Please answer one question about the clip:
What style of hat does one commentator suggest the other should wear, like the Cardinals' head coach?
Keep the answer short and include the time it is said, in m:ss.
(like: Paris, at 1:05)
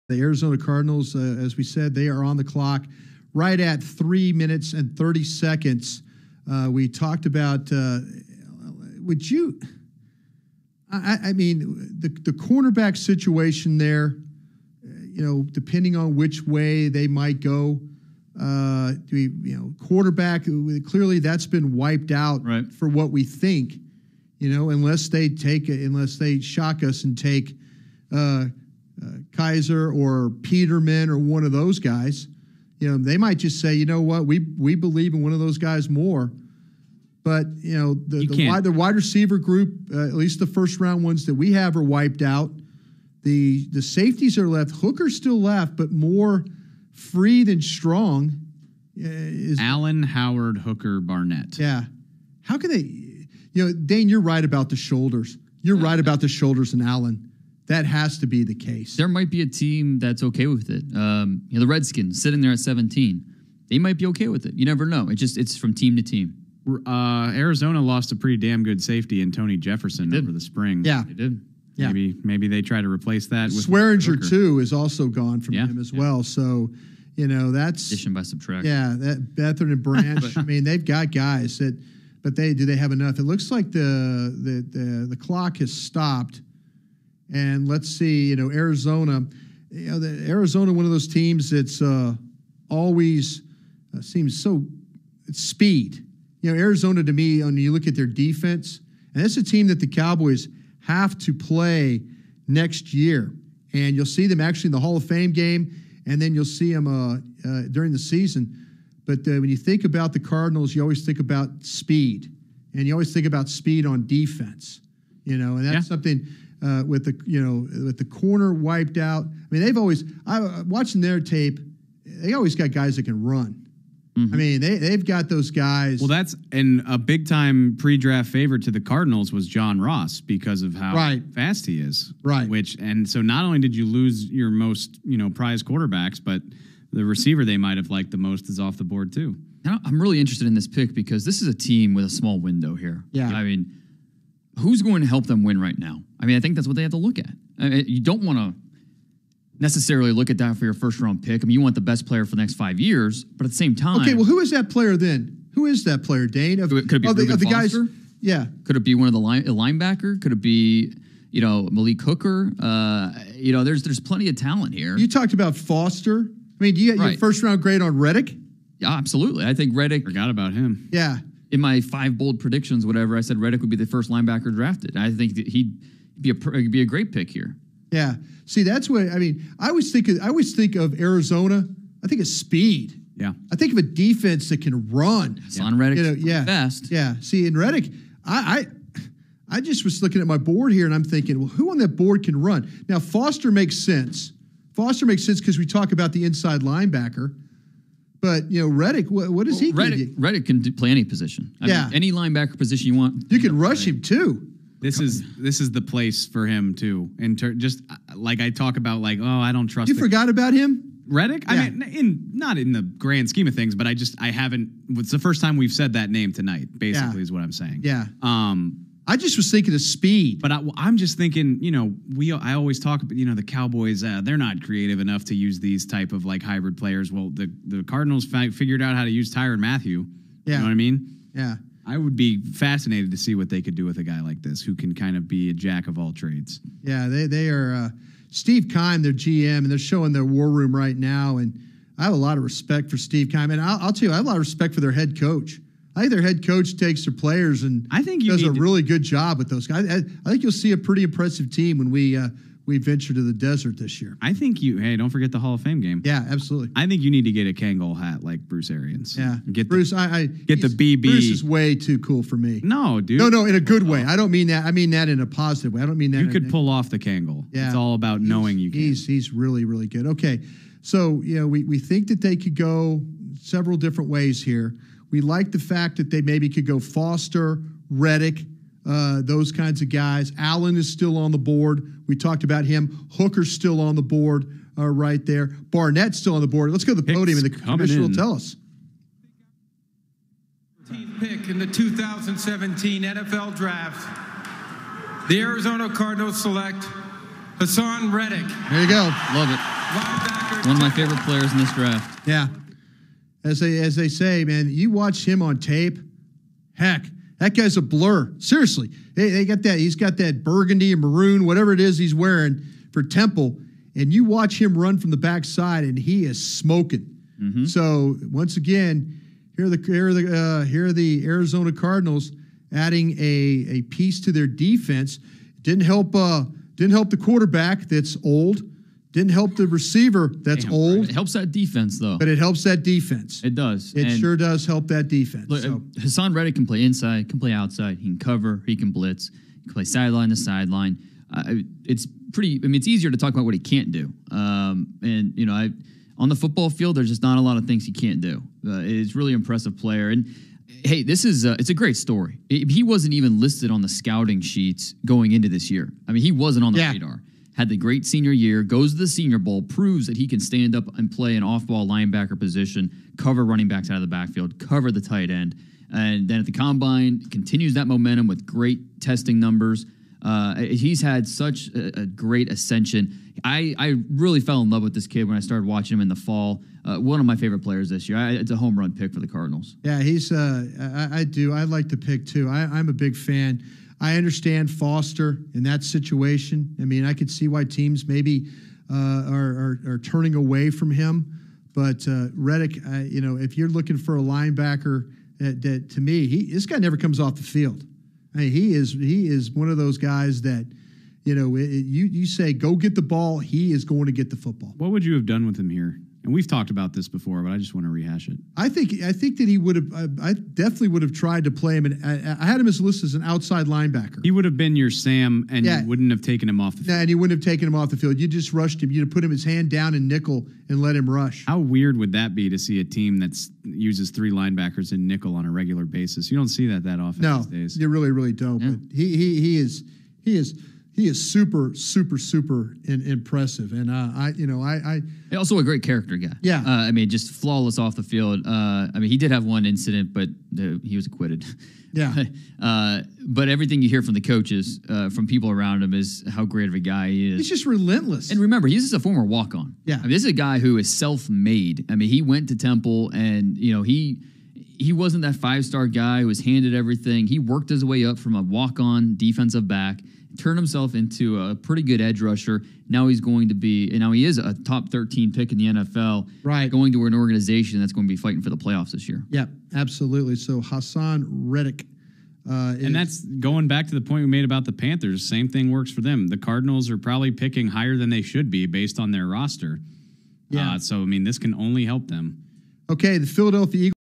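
Kangol hat, at 4:17.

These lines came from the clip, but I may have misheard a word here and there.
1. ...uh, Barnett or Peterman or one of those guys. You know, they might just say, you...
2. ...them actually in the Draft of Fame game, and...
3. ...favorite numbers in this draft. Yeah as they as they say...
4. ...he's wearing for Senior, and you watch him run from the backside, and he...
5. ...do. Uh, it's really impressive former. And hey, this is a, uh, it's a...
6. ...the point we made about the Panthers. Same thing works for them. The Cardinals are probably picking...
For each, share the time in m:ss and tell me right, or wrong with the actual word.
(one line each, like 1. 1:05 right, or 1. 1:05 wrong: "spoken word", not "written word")
1. 0:28 wrong: "Kizer", not "Barnett"
2. 1:44 wrong: "Hall", not "Draft"
3. 5:00 wrong: "players", not "numbers"
4. 5:11 wrong: "Temple", not "Senior"
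5. 5:48 wrong: "player", not "former"
6. 7:53 right.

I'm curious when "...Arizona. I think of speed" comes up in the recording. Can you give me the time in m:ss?
3:00.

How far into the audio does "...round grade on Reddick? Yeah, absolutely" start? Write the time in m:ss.
2:47.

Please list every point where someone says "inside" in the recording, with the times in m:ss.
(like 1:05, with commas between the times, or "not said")
3:16, 5:36.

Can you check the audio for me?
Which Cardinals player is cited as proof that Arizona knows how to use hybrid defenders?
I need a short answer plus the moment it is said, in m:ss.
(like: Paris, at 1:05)
Tyrann Mathieu, at 3:49.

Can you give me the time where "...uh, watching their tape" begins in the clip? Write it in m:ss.
2:00.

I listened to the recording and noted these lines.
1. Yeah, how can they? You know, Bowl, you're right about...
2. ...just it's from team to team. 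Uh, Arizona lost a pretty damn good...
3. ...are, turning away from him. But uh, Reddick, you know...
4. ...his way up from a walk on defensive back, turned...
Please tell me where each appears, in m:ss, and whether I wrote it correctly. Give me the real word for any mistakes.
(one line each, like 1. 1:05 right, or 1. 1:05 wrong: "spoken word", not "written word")
1. 0:51 wrong: "Dane", not "Bowl"
2. 1:05 right
3. 6:29 right
4. 7:37 right.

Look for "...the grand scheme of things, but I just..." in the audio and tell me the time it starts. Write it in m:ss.
3:32.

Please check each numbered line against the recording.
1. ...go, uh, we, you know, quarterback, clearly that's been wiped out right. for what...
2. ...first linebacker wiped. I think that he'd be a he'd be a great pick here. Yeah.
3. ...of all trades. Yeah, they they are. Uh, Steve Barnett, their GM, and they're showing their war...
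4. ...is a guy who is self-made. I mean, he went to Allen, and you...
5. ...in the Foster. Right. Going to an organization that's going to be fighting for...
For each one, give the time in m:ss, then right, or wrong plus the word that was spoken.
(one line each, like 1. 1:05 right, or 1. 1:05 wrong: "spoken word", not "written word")
1. 0:17 right
2. 2:53 wrong: "drafted", not "wiped"
3. 3:55 wrong: "Keim", not "Barnett"
4. 7:30 wrong: "Temple", not "Allen"
5. 7:45 wrong: "NFL", not "Foster".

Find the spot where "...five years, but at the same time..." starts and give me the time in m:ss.
2:32.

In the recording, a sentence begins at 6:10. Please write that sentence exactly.
Uh, he's had such a, a, great ascension.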